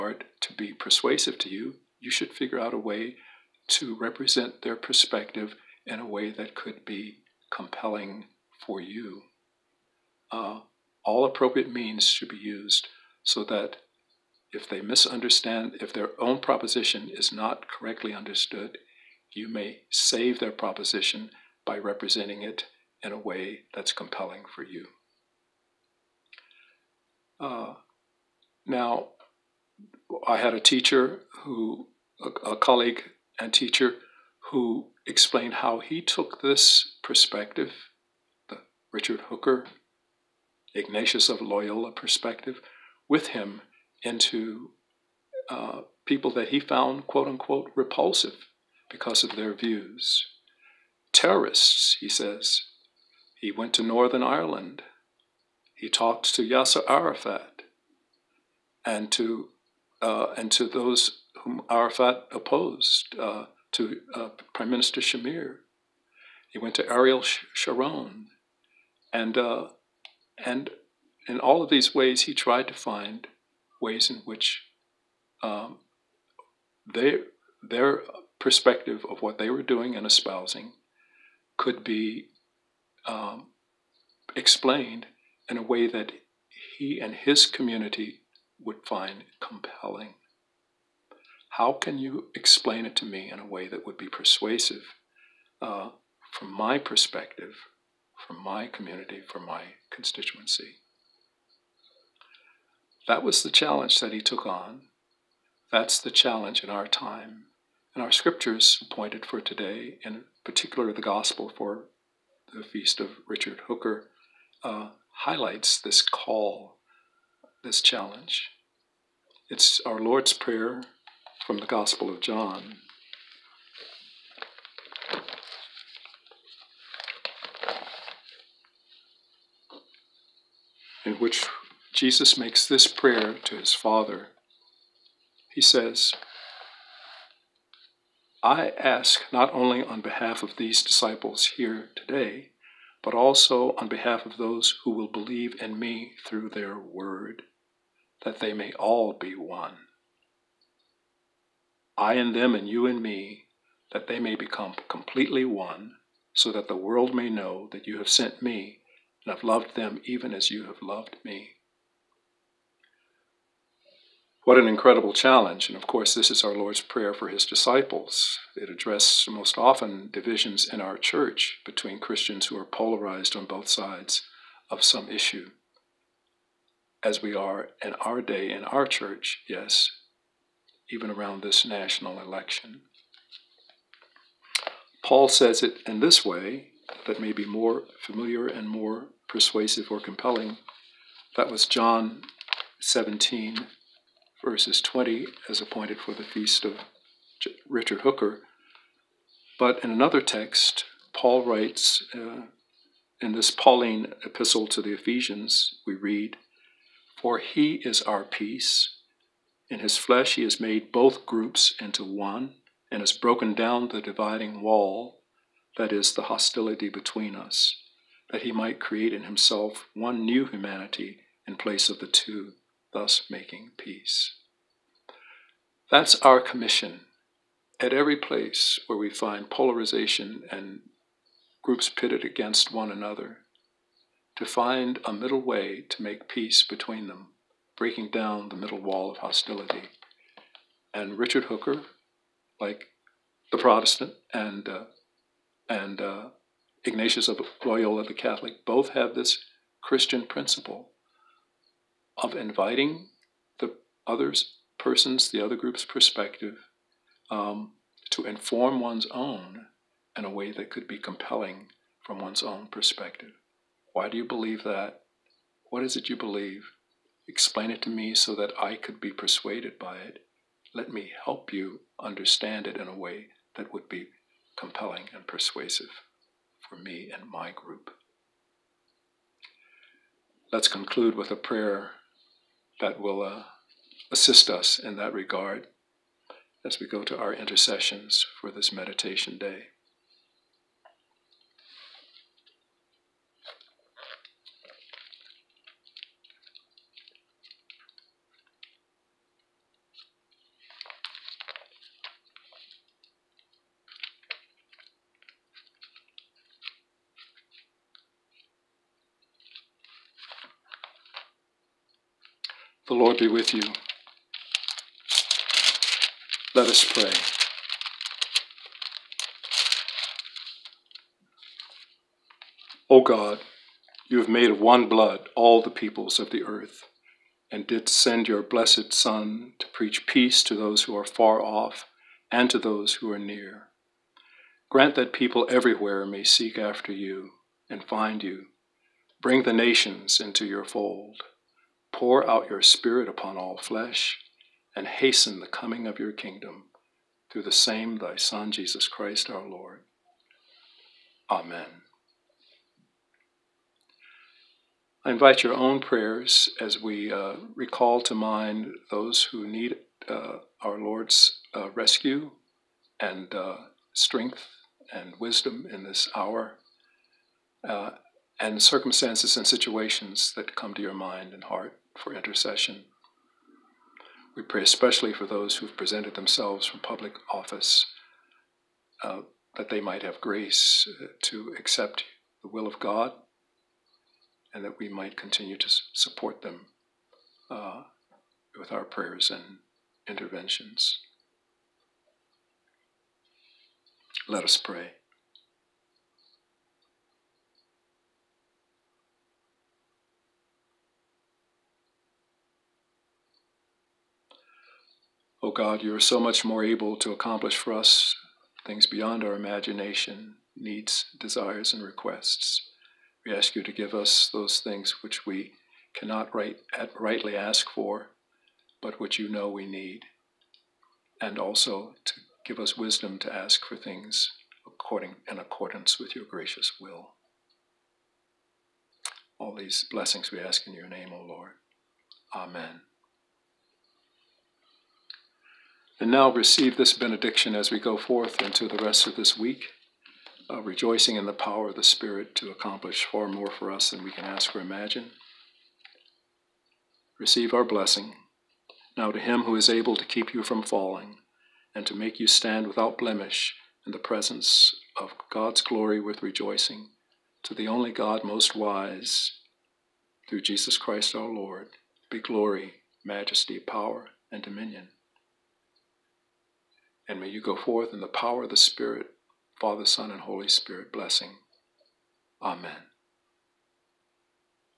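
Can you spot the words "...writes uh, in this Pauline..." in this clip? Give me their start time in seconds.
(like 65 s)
201 s.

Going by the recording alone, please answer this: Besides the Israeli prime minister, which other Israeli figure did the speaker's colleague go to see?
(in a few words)
Ariel Sharon.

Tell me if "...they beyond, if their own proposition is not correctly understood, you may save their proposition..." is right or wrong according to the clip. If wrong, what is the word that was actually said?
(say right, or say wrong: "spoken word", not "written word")
wrong: "misunderstand", not "beyond".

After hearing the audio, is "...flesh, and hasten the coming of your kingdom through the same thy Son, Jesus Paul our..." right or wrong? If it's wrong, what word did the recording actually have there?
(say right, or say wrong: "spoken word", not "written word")
wrong: "Christ", not "Paul".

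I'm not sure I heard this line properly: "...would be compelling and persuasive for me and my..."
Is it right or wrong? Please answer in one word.
right.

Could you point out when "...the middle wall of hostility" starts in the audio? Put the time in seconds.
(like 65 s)
238 s.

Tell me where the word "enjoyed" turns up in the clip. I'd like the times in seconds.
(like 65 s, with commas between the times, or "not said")
not said.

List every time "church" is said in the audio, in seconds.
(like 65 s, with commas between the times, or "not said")
170 s, 178 s.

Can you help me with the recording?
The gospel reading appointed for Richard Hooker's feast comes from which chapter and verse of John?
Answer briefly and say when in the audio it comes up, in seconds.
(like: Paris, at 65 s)
John 17:20, at 191 s.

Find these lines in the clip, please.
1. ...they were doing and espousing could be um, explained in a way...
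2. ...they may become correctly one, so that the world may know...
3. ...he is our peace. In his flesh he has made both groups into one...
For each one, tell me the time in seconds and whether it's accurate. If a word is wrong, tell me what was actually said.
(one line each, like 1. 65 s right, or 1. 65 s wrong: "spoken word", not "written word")
1. 79 s right
2. 154 s wrong: "completely", not "correctly"
3. 207 s right.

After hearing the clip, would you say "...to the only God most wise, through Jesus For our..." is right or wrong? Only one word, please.
wrong.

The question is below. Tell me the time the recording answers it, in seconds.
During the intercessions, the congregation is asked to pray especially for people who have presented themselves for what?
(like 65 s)
376 s.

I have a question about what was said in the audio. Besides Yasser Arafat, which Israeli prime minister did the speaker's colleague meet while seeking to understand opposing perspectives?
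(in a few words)
Shamir.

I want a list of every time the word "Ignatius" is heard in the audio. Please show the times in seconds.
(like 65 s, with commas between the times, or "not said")
40 s, 246 s.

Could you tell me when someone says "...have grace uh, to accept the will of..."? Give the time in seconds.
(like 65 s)
380 s.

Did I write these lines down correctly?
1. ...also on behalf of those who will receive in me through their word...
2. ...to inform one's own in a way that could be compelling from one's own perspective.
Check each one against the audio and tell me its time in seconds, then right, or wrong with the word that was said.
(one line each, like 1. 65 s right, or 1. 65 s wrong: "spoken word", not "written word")
1. 143 s wrong: "believe", not "receive"
2. 258 s right.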